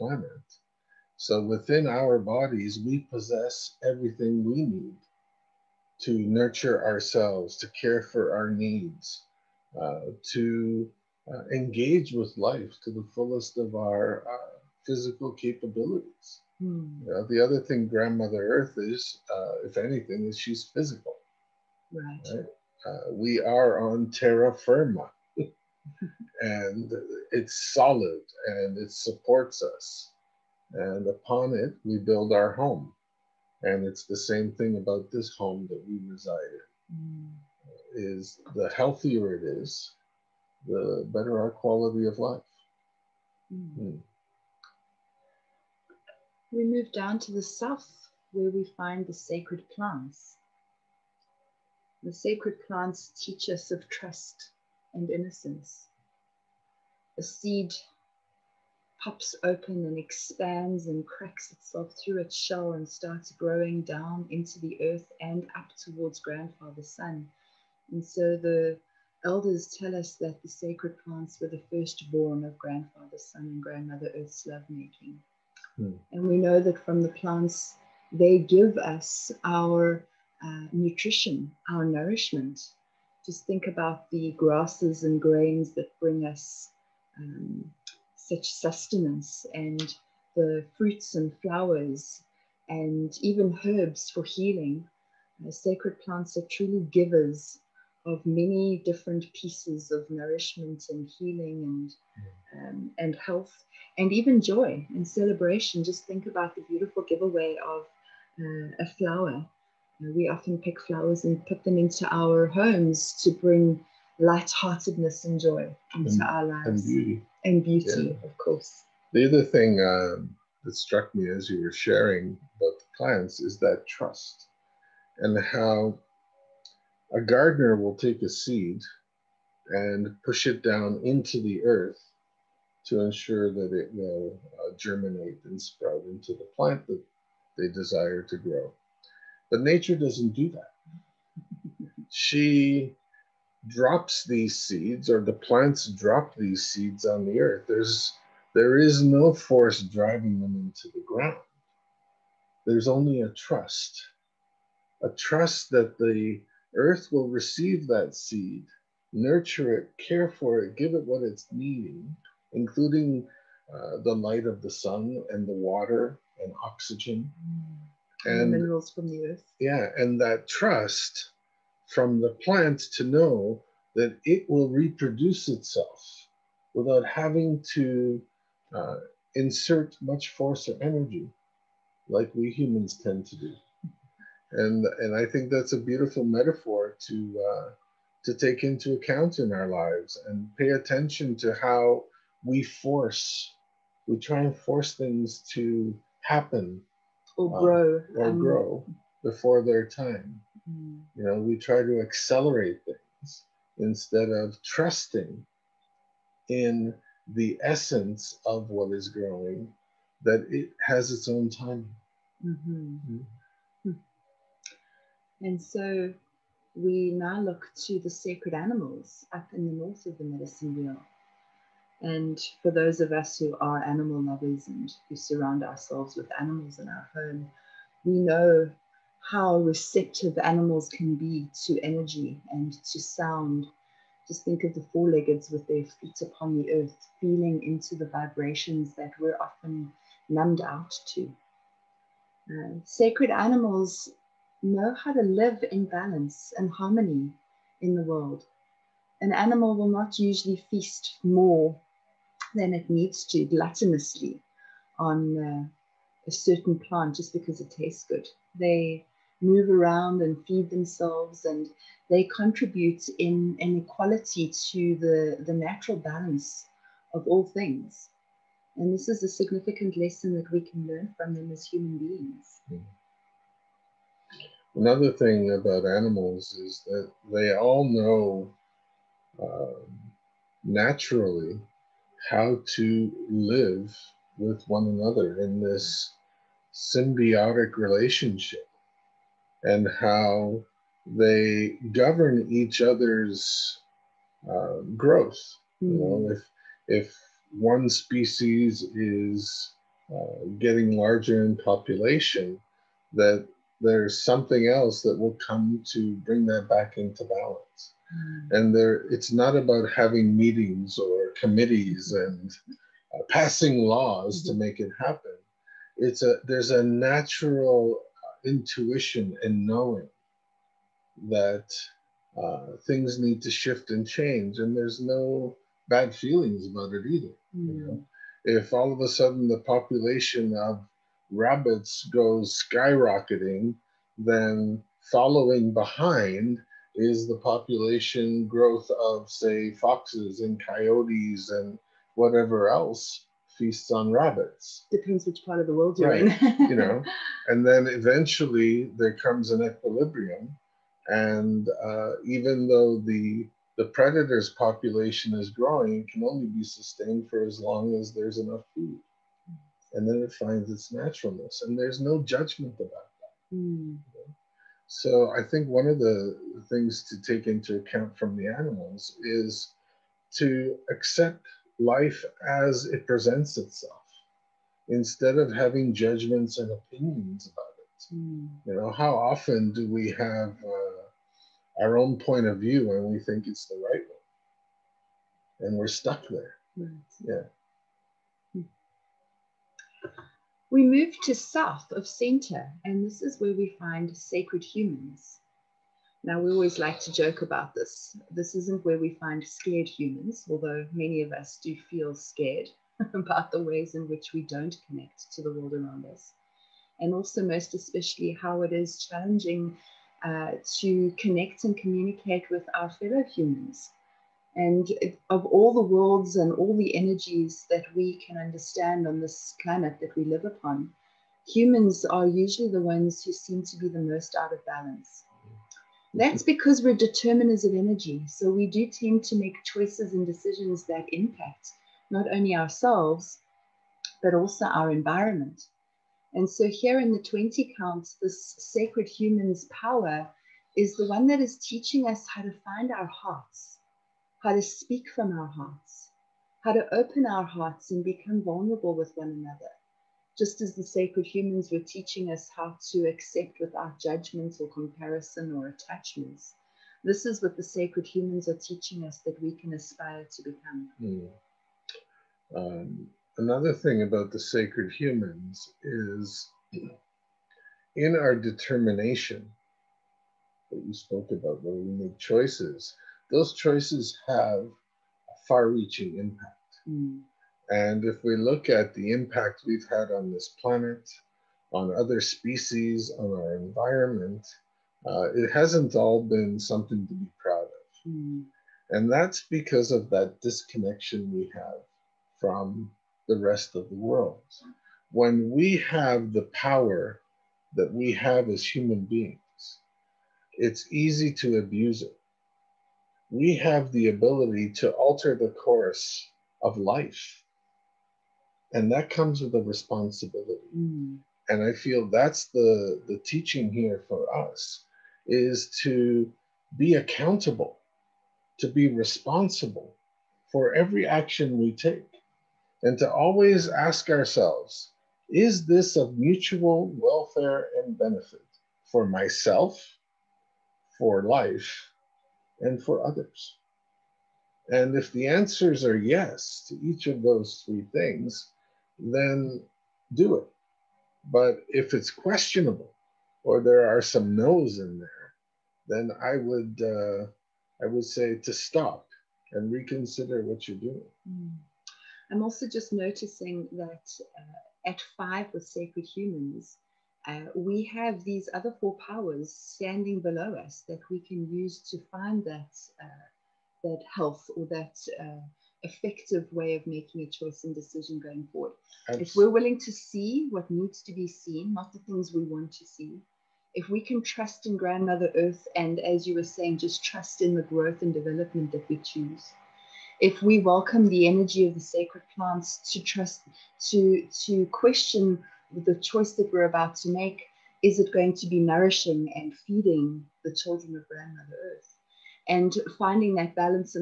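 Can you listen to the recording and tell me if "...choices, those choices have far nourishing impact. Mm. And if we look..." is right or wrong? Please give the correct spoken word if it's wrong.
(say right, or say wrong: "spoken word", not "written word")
wrong: "reaching", not "nourishing".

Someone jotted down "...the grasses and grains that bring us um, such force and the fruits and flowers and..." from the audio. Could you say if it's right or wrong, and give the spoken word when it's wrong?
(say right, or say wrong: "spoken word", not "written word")
wrong: "sustenance", not "force".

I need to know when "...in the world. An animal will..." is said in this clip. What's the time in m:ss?
4:07.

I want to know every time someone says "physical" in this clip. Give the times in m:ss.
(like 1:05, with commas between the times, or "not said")
0:14, 0:20.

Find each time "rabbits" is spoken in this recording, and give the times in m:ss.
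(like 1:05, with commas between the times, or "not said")
5:31, 5:44.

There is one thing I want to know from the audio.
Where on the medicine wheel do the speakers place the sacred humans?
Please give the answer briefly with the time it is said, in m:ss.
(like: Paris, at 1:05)
South of center, at 6:31.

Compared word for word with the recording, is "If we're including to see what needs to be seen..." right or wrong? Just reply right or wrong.
wrong.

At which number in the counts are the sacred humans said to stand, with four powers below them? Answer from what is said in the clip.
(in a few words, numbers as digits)
5.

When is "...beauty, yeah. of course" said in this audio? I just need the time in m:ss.
1:57.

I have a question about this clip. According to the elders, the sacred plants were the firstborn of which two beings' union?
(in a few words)
Grandfather Sun and Grandmother Earth.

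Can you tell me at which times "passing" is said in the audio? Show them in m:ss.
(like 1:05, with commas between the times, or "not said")
5:13.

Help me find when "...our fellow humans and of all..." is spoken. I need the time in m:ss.
6:52.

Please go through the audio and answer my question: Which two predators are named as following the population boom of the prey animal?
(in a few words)
Foxes and coyotes.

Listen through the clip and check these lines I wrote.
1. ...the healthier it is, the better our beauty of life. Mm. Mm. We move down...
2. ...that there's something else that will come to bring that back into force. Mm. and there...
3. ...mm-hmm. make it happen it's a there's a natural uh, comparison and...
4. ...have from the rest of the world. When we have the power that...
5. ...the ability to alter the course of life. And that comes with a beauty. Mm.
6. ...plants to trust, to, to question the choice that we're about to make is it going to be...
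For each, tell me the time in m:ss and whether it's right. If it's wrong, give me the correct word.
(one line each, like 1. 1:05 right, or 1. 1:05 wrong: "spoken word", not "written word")
1. 0:38 wrong: "quality", not "beauty"
2. 5:03 wrong: "balance", not "force"
3. 5:14 wrong: "intuition", not "comparison"
4. 8:11 right
5. 8:23 wrong: "responsibility", not "beauty"
6. 9:42 right.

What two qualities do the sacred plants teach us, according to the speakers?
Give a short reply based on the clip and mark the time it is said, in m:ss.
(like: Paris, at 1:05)
Trust and innocence, at 0:53.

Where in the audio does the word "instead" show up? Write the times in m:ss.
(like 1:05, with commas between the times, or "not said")
3:23, 6:14.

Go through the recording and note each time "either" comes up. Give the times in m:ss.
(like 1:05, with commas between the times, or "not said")
5:27.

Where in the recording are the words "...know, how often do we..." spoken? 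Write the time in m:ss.
6:18.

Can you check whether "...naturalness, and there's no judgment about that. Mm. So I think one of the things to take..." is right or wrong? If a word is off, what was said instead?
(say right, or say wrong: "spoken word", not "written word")
right.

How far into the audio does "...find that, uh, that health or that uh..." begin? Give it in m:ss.
9:22.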